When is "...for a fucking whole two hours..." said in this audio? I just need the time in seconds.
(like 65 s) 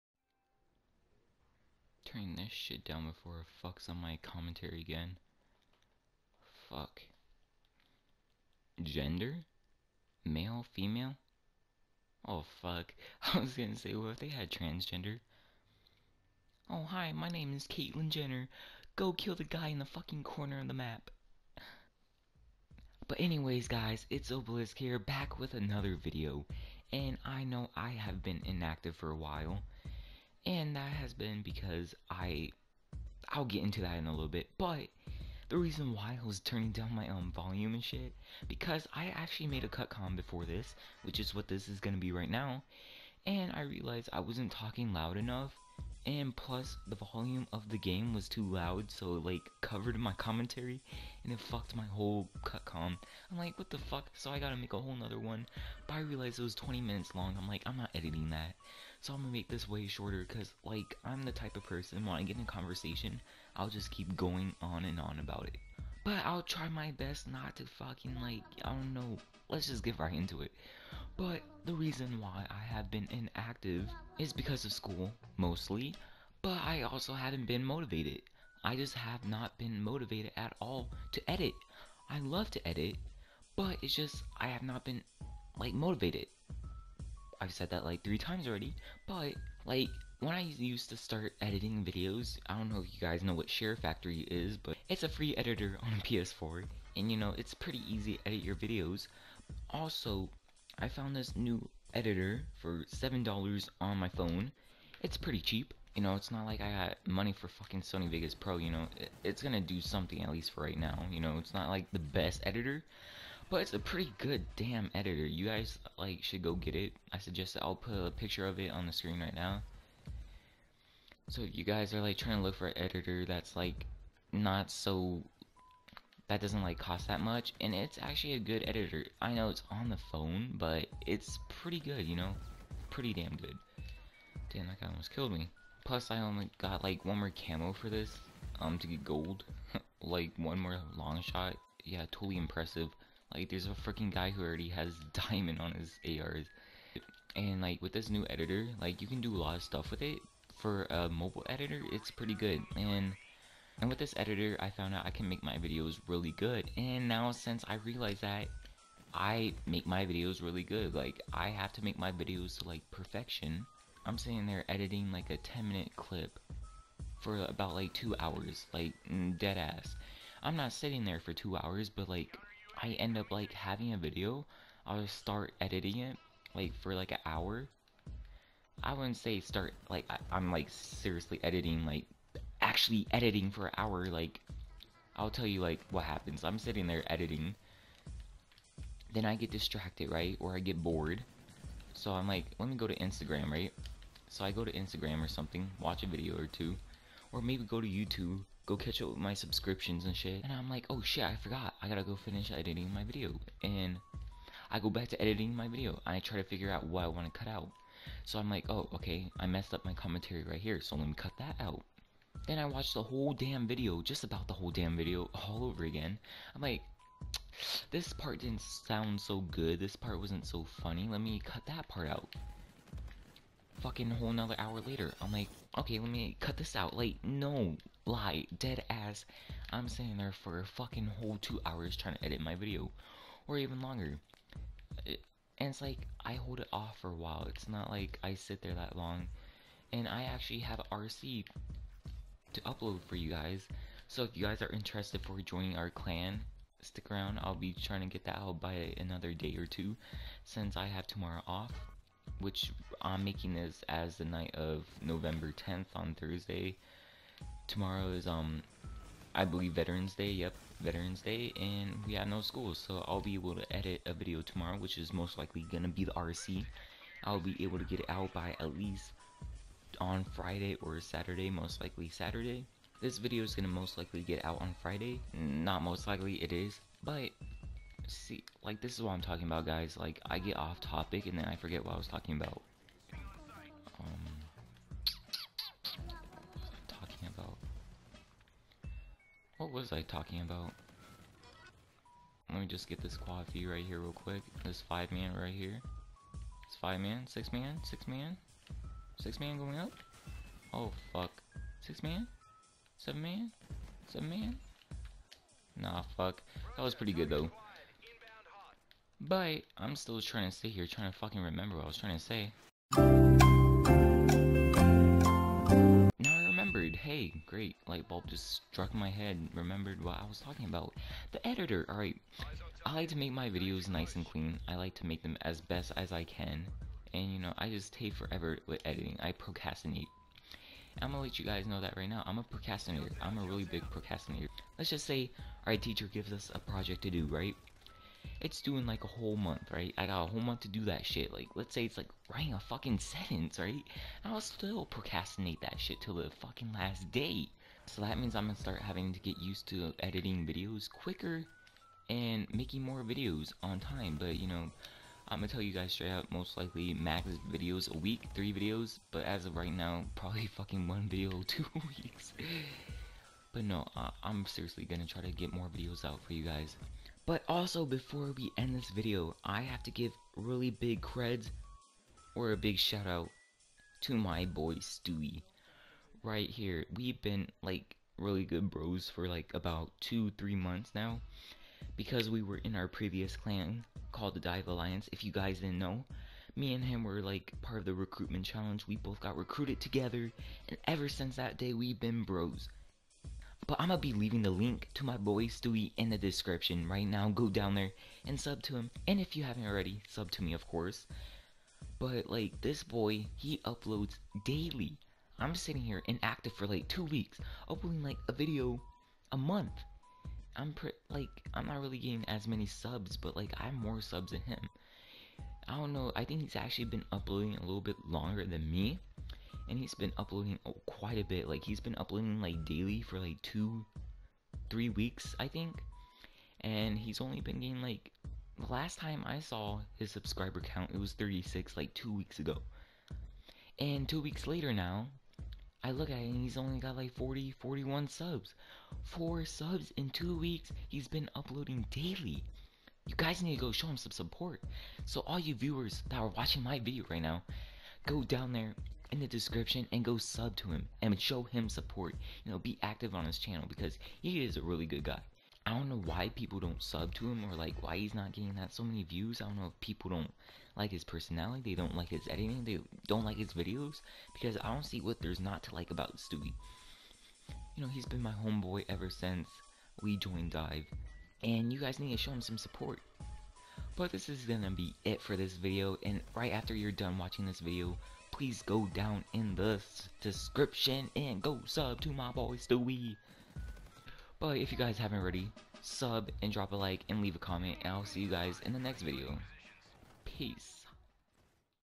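230 s.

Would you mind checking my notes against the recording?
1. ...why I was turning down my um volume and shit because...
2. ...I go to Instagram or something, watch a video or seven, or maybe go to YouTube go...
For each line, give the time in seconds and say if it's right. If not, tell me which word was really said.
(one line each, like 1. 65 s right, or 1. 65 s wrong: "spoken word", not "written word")
1. 35 s right
2. 194 s wrong: "two", not "seven".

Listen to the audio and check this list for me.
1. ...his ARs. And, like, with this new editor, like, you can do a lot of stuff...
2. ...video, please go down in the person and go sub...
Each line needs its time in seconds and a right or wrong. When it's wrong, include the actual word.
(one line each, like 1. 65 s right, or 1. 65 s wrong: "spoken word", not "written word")
1. 145 s right
2. 477 s wrong: "description", not "person".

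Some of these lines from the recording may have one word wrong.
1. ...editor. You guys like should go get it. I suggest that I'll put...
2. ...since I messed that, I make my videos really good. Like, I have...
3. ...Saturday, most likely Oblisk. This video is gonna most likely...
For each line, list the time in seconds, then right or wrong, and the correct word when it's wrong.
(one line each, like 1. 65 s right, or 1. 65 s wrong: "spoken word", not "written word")
1. 114 s right
2. 157 s wrong: "realized", not "messed"
3. 270 s wrong: "Saturday", not "Oblisk".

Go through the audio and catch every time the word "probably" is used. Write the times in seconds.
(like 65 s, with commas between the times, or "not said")
360 s.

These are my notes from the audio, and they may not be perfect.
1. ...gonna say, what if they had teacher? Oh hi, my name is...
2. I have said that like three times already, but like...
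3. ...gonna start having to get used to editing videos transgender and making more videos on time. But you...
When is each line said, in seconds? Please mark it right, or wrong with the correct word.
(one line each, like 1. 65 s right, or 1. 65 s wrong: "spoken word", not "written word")
1. 13 s wrong: "transgender", not "teacher"
2. 87 s right
3. 348 s wrong: "quicker", not "transgender".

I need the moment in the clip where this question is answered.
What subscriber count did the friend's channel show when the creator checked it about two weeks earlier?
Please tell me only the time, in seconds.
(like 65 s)
431 s.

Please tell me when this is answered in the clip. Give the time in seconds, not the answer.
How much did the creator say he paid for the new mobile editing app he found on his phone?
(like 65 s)
102 s.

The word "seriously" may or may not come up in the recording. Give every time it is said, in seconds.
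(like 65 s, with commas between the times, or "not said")
180 s, 364 s.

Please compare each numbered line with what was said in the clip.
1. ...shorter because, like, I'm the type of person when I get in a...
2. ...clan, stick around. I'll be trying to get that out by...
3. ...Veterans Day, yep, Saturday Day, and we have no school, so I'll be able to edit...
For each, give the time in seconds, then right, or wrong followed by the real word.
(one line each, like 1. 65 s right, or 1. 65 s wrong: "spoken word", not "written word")
1. 59 s right
2. 245 s right
3. 259 s wrong: "Veterans", not "Saturday".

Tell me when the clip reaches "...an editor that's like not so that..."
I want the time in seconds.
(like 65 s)
122 s.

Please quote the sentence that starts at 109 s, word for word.
it's gonna do something, at least for right now.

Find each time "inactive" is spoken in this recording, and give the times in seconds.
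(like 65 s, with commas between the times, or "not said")
28 s, 73 s, 406 s.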